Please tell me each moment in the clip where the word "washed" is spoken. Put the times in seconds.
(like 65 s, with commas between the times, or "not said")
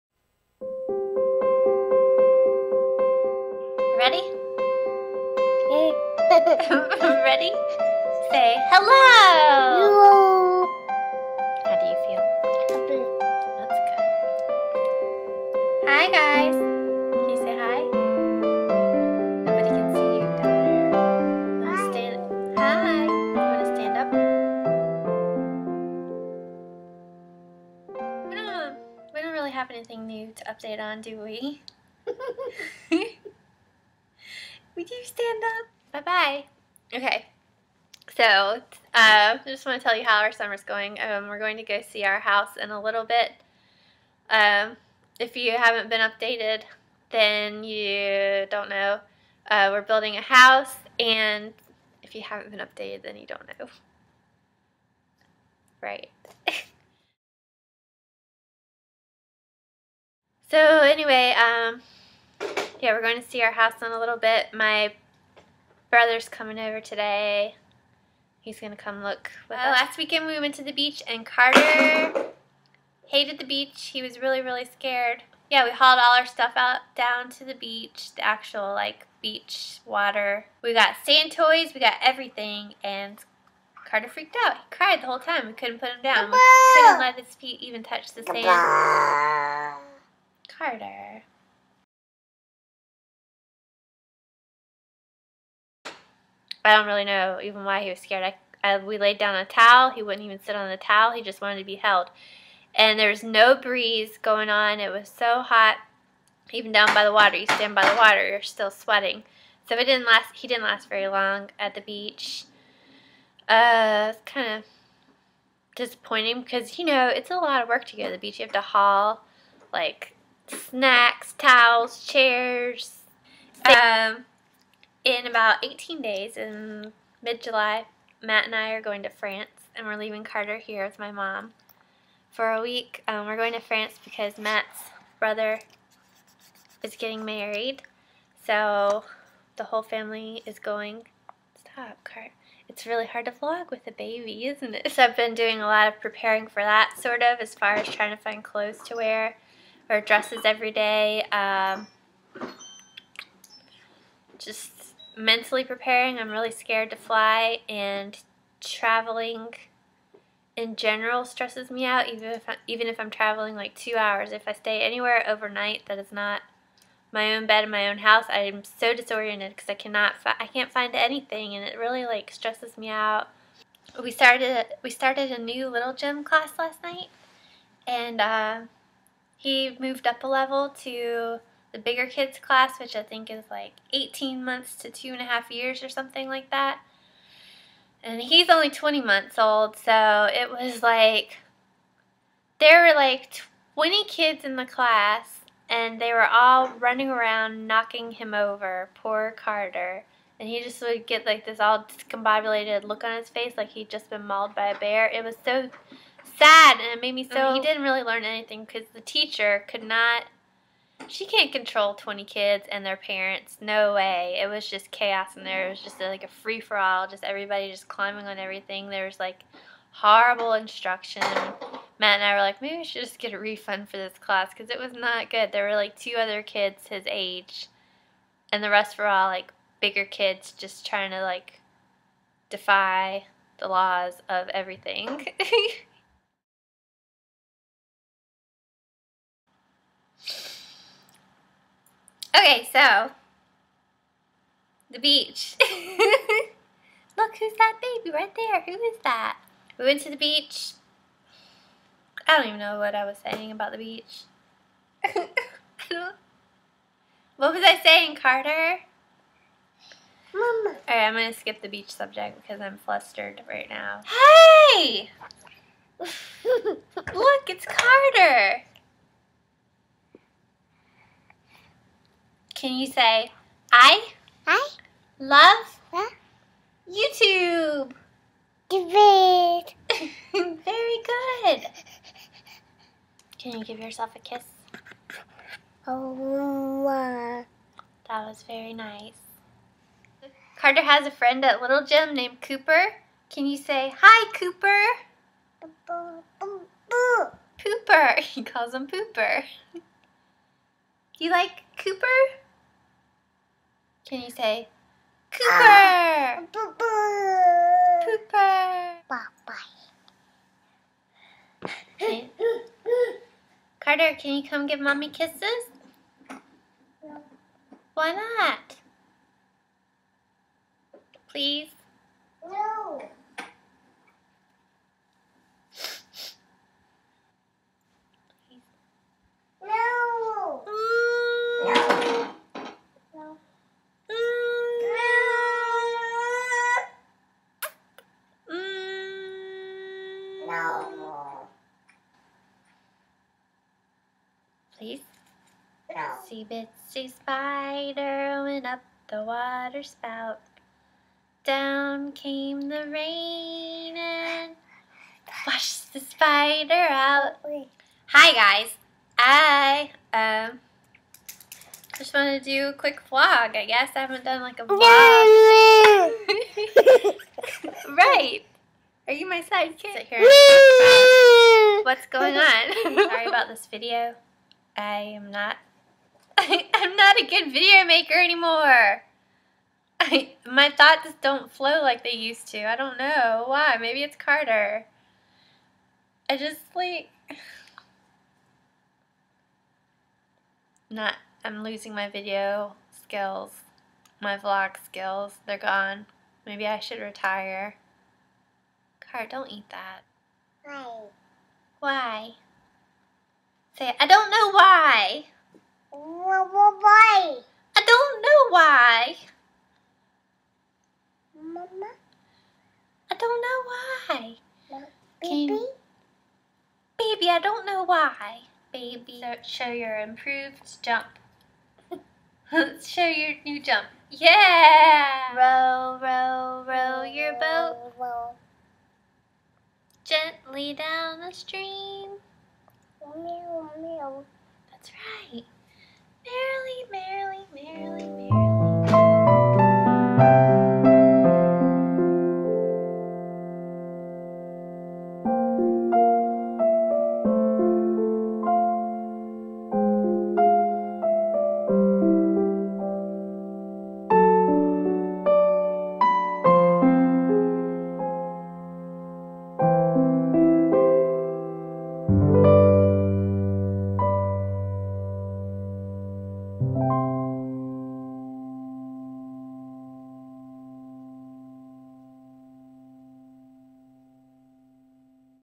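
355 s.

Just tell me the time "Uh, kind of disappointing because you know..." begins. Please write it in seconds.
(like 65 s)
113 s.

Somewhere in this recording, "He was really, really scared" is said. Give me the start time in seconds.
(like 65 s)
73 s.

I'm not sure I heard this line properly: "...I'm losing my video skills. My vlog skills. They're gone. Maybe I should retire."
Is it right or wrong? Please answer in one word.
right.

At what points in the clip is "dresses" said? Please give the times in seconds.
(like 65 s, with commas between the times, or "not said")
149 s.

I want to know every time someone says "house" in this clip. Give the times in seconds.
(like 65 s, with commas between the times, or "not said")
42 s, 50 s, 63 s, 167 s.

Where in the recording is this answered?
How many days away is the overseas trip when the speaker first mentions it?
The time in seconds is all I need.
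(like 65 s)
125 s.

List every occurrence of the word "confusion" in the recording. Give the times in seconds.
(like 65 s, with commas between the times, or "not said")
not said.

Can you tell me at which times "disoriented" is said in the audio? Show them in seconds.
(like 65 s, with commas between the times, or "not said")
168 s.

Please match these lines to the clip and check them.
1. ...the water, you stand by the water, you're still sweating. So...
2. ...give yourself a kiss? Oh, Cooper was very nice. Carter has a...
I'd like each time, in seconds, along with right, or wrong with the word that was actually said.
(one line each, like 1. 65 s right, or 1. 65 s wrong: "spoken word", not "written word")
1. 107 s right
2. 283 s wrong: "That", not "Cooper".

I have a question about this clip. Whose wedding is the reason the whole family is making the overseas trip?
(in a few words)
Matt's brother.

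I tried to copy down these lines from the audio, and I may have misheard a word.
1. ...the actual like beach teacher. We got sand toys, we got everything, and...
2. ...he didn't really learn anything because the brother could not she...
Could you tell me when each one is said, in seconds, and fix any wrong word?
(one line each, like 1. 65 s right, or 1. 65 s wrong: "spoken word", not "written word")
1. 78 s wrong: "water", not "teacher"
2. 207 s wrong: "teacher", not "brother".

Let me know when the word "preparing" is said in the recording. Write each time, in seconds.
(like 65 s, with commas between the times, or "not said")
145 s, 155 s.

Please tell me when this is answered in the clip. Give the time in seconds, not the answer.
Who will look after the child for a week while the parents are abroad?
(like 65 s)
130 s.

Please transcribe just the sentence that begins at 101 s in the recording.
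He just wanted to be held.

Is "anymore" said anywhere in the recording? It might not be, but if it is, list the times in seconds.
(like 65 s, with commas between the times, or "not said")
378 s.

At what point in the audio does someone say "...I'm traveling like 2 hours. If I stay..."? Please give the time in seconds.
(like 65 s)
162 s.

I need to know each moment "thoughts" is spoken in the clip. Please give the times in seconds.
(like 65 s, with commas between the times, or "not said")
380 s.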